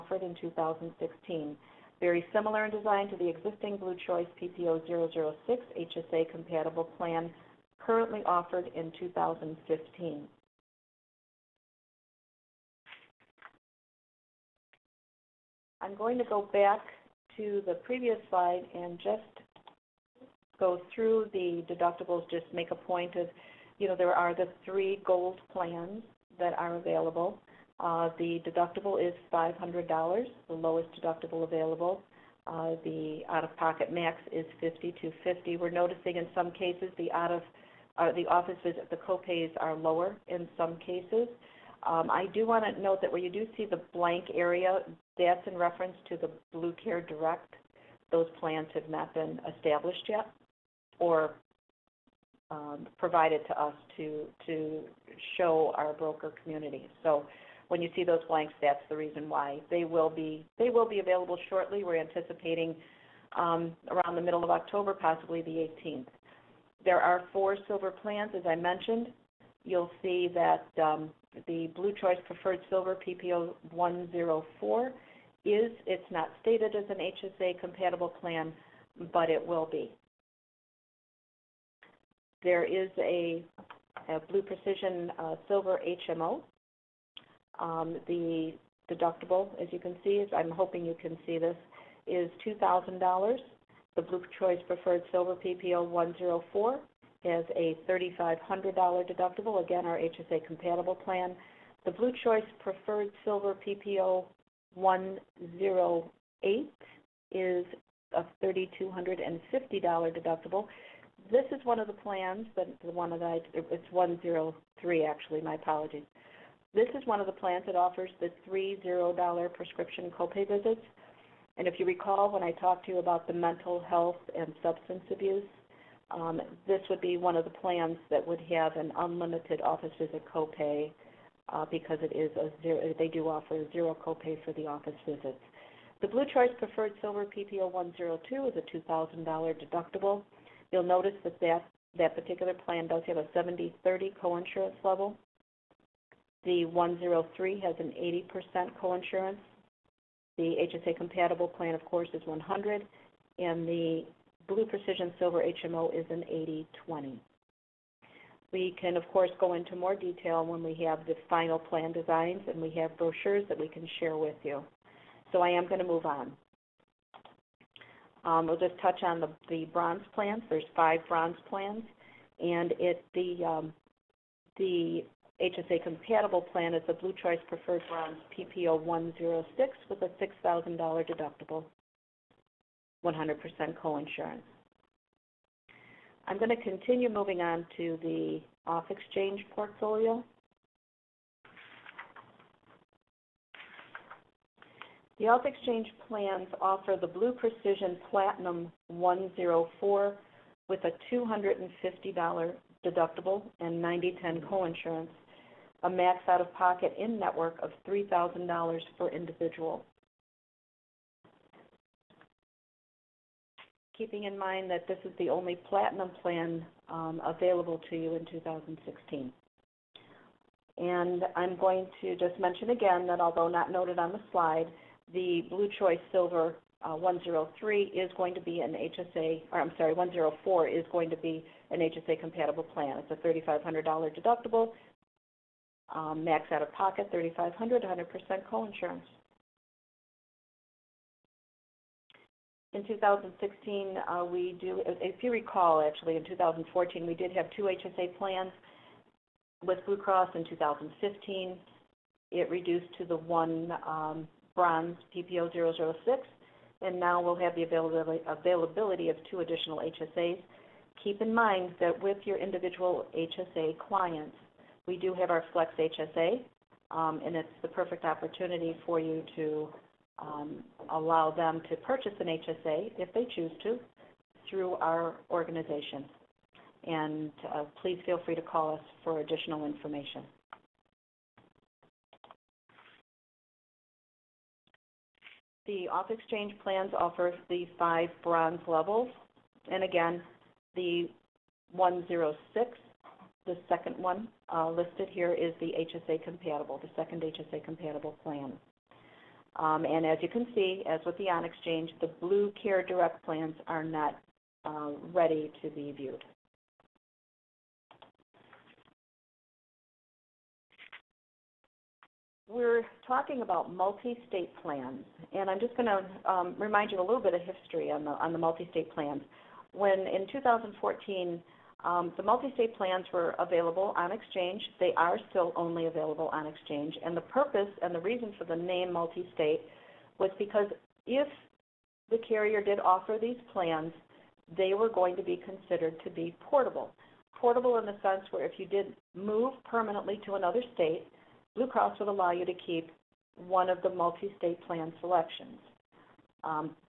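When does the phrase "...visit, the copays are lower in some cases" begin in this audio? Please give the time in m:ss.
0:38.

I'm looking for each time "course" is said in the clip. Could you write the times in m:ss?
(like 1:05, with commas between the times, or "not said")
2:31, 2:39.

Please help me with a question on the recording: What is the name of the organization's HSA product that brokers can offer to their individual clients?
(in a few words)
Flex HSA.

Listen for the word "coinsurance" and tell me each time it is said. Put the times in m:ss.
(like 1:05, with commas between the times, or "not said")
2:24, 2:28, 3:03, 3:24.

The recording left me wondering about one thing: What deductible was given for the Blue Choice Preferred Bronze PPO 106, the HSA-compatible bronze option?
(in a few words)
$6,000.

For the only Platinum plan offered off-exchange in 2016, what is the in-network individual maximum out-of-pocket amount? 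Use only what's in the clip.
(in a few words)
$3,000.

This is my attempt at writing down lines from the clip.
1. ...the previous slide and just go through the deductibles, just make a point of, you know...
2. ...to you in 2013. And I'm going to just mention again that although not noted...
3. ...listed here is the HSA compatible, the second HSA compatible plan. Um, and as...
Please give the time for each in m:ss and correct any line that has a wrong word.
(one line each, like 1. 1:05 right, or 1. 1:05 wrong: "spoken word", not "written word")
1. 0:17 right
2. 3:37 wrong: "2016", not "2013"
3. 4:54 right.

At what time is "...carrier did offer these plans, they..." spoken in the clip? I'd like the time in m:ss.
5:32.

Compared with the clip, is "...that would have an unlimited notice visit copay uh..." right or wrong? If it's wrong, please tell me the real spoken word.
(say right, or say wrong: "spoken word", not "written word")
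wrong: "office", not "notice".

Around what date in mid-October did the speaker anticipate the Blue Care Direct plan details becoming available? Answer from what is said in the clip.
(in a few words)
the 18th.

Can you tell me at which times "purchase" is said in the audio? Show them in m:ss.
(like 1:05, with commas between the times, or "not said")
4:31.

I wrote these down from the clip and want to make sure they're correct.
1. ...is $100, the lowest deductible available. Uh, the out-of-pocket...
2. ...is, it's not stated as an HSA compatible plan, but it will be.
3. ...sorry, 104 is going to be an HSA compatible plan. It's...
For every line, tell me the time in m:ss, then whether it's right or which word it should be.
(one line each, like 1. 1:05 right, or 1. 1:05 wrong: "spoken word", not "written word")
1. 0:29 wrong: "500", not "100"
2. 1:15 right
3. 3:49 right.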